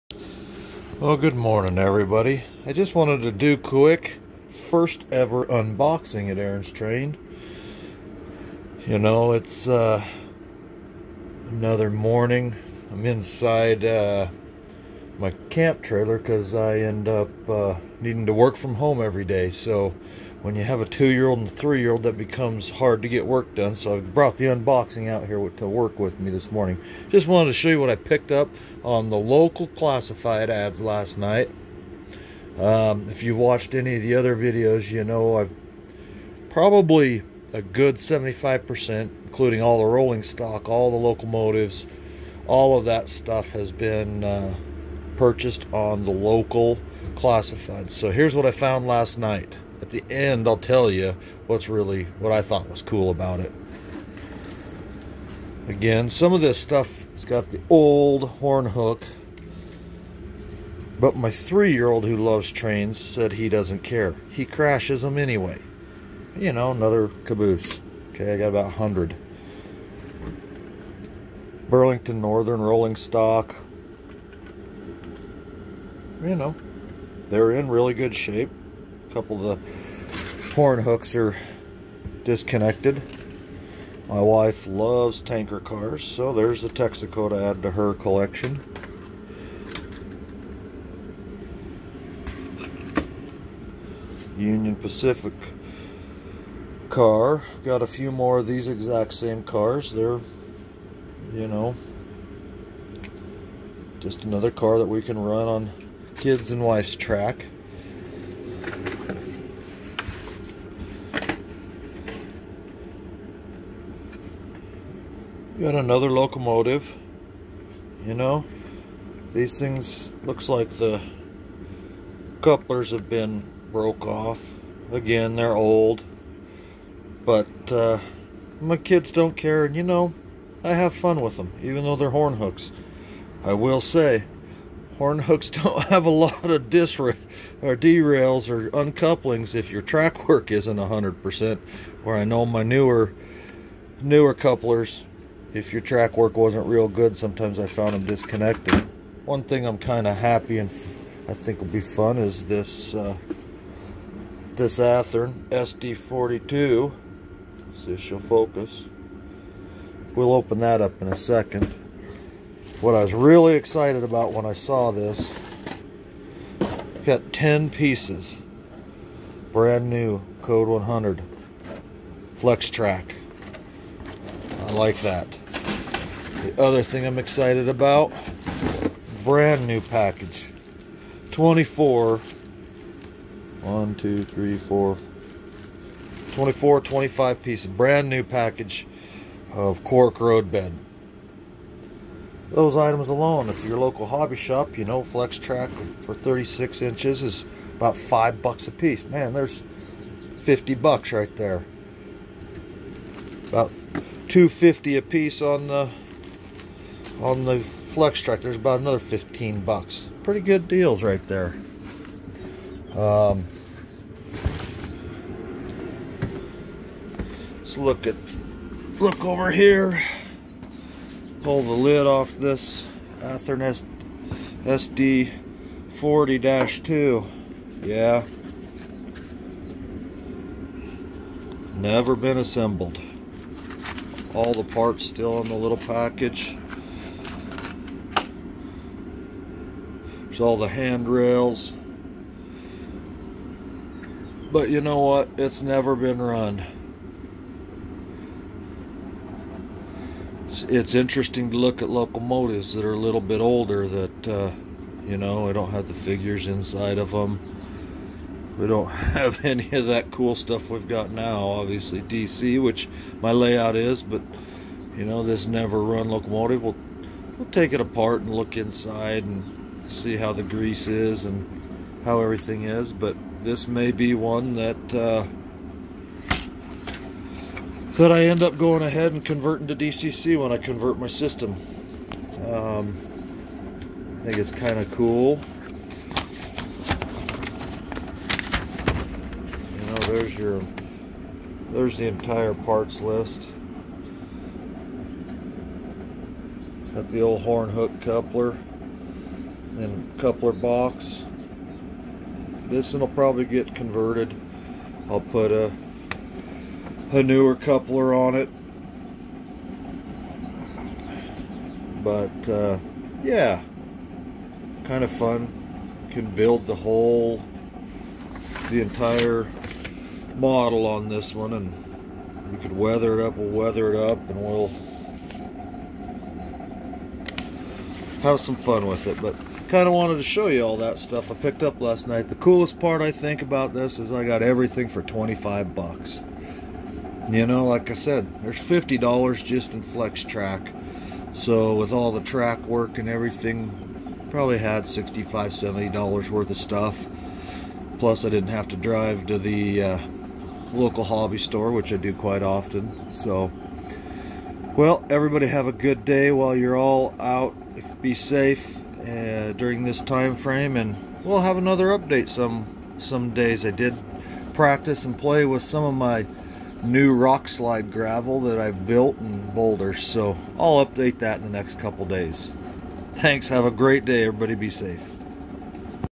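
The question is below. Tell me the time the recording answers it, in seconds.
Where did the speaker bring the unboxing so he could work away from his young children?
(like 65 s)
15 s.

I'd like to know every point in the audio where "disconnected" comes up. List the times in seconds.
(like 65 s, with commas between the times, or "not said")
82 s, 148 s.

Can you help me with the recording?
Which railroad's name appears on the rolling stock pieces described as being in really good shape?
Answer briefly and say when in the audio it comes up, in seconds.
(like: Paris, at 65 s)
Burlington Northern, at 71 s.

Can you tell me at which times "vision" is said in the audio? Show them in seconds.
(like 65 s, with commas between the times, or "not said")
not said.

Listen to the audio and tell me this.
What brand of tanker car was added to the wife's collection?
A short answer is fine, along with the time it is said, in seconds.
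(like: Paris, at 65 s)
Texaco, at 86 s.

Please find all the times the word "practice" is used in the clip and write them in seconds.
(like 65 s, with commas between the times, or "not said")
364 s.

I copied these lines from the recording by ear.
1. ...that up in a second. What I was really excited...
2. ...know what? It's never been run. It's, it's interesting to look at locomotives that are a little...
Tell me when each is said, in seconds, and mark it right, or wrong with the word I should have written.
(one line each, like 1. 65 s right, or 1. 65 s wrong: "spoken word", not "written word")
1. 160 s right
2. 244 s right.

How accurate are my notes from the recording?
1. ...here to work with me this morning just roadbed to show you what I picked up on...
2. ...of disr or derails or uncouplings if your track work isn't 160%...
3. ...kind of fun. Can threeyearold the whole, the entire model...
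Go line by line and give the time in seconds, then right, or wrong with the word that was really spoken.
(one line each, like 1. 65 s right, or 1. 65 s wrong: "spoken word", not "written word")
1. 25 s wrong: "wanted", not "roadbed"
2. 136 s wrong: "100", not "160"
3. 314 s wrong: "build", not "threeyearold".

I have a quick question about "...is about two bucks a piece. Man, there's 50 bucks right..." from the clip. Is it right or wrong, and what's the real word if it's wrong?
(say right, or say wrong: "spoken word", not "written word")
wrong: "five", not "two".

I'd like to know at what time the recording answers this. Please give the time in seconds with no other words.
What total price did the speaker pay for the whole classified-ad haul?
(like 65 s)
335 s.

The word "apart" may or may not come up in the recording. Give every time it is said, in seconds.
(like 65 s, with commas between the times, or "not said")
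267 s.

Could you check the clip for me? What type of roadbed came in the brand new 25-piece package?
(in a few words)
cork.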